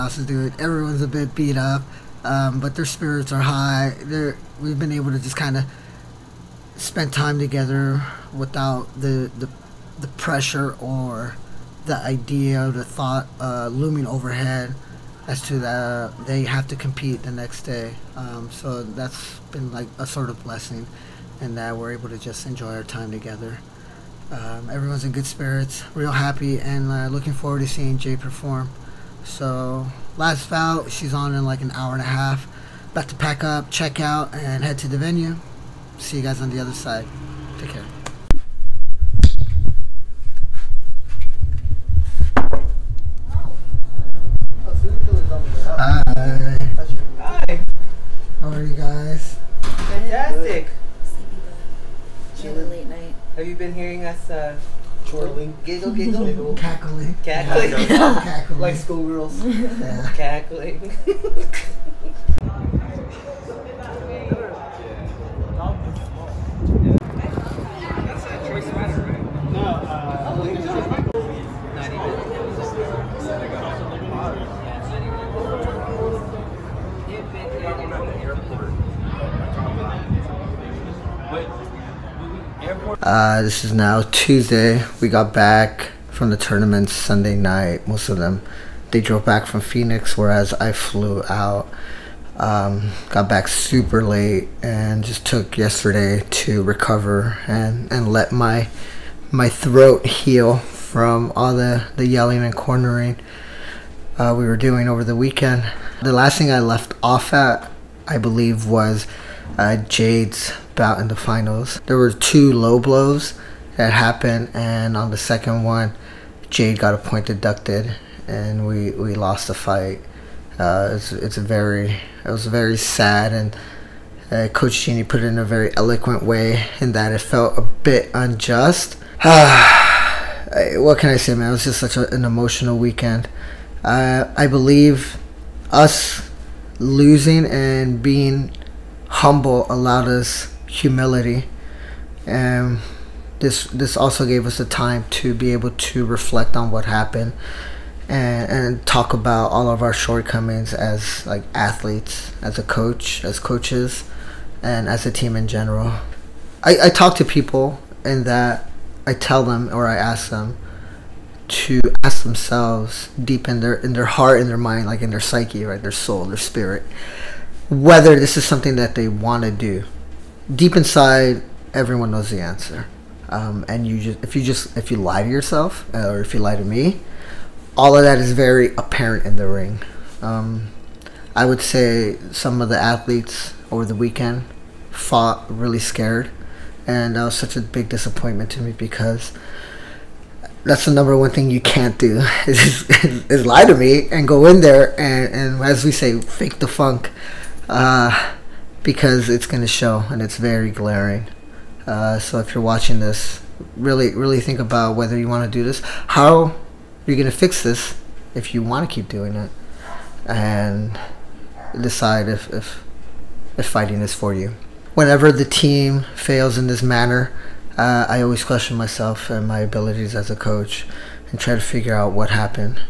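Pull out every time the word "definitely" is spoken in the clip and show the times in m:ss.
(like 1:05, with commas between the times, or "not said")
not said.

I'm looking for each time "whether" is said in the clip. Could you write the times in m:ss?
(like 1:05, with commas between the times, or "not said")
2:47, 3:24.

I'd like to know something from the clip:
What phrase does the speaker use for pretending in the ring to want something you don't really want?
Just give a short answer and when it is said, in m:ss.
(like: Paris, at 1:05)
fake the funk, at 3:16.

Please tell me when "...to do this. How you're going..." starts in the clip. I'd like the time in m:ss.
3:25.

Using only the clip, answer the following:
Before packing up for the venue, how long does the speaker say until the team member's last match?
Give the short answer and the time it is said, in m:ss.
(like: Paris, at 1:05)
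an hour and a half, at 0:31.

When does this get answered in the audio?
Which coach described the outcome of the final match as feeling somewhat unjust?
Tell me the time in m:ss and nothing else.
2:04.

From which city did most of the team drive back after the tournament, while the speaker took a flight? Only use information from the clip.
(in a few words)
Phoenix.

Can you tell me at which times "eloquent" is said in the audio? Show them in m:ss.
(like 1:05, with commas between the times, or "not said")
2:05.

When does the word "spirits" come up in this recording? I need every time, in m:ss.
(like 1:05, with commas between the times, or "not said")
0:02, 0:25, 2:46.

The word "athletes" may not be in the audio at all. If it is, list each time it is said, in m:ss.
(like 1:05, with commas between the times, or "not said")
2:31, 3:02.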